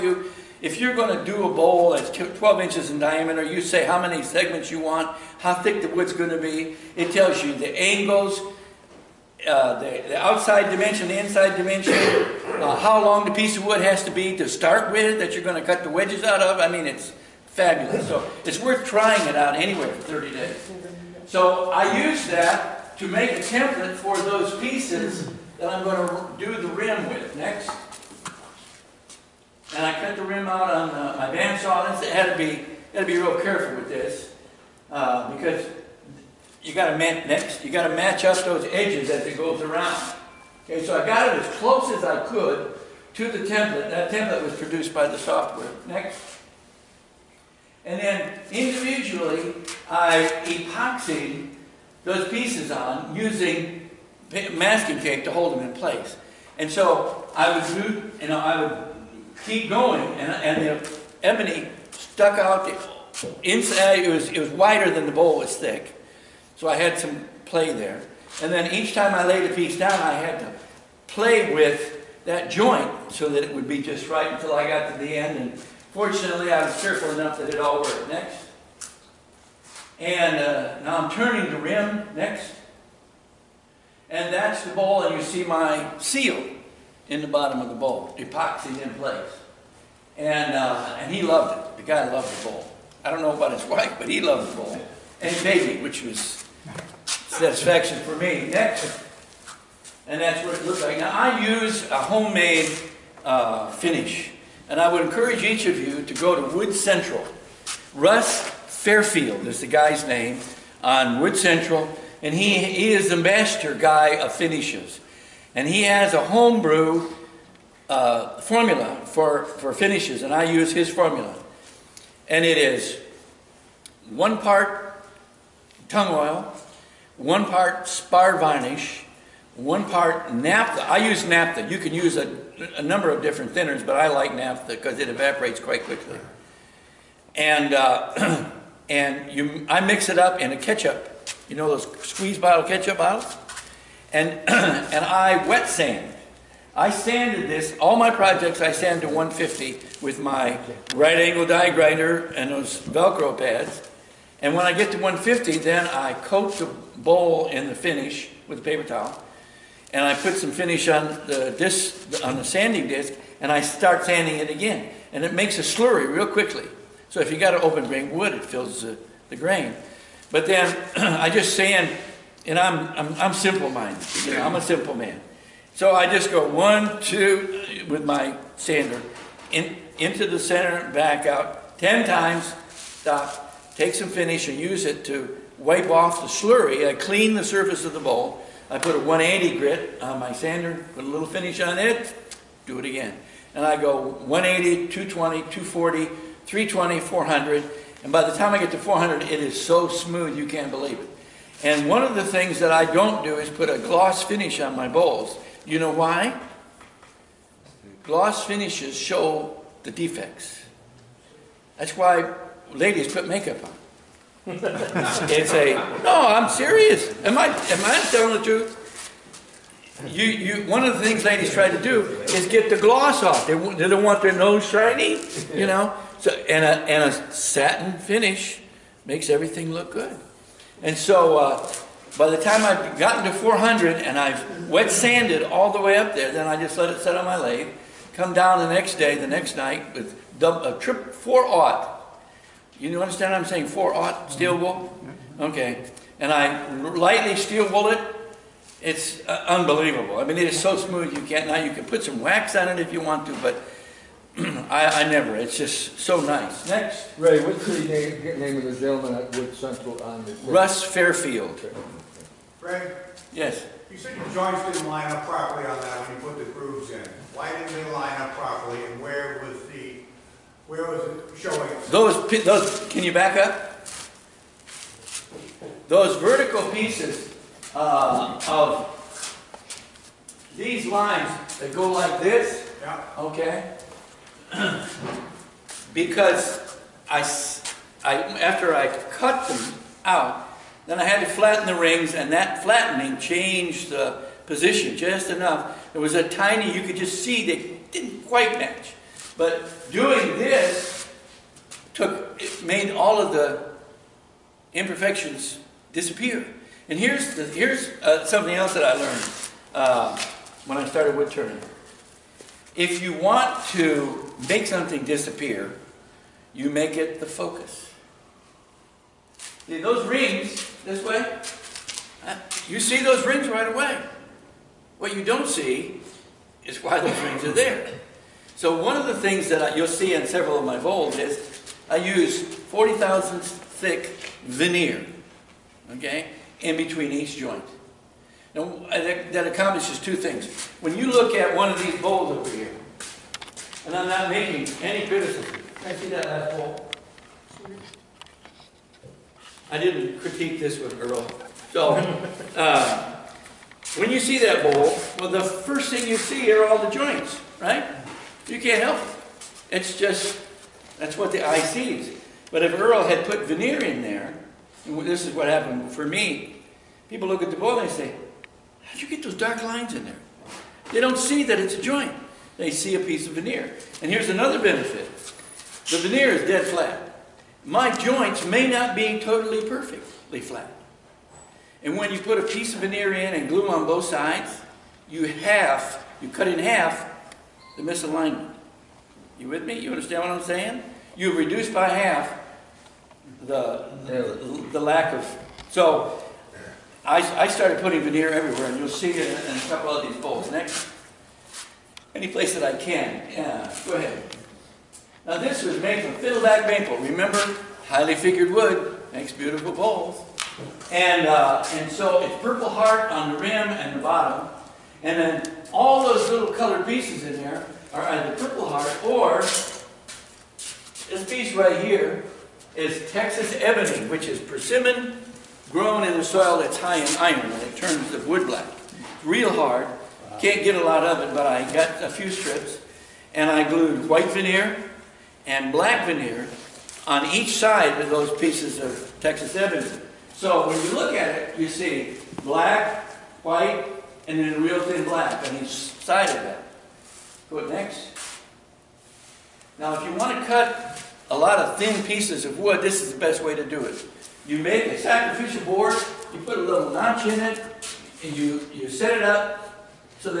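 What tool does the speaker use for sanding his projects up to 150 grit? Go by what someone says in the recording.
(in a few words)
right angle die grinder.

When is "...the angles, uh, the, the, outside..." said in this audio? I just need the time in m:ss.
0:07.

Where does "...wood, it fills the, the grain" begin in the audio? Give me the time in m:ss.
2:48.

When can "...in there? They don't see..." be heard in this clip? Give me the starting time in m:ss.
6:09.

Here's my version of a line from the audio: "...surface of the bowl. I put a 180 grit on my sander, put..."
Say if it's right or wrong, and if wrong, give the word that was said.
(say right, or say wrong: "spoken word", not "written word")
right.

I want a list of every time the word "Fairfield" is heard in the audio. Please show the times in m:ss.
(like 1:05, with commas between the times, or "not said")
1:48, 4:20.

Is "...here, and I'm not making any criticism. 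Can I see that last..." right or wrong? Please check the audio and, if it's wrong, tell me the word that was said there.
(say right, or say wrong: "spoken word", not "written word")
right.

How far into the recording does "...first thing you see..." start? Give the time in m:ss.
5:55.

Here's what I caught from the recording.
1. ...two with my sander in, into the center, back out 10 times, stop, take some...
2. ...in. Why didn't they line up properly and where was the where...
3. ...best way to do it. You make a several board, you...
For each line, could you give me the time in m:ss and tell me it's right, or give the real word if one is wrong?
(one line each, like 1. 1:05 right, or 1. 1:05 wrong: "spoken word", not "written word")
1. 2:57 right
2. 4:26 right
3. 7:33 wrong: "sacrificial", not "several".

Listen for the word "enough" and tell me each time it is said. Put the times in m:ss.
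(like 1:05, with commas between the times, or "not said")
1:17, 4:55.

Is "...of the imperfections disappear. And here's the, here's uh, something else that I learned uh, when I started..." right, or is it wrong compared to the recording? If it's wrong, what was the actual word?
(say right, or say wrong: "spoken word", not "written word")
right.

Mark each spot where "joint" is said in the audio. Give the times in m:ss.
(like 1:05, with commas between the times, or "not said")
1:12, 4:24, 5:37, 5:56, 6:11, 6:17.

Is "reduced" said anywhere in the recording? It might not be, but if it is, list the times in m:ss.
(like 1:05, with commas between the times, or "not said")
6:31.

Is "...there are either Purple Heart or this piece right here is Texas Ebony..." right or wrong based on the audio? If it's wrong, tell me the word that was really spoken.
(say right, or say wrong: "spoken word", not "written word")
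right.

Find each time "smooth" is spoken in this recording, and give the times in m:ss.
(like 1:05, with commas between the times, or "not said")
3:19, 4:10.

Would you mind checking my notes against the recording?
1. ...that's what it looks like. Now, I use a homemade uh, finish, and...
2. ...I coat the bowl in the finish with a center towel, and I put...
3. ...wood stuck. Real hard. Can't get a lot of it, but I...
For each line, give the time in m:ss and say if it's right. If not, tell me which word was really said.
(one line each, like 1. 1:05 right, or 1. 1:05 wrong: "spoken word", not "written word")
1. 1:40 right
2. 2:35 wrong: "paper", not "center"
3. 7:08 wrong: "black", not "stuck".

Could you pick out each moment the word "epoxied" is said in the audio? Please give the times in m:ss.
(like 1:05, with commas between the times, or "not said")
0:50, 1:28.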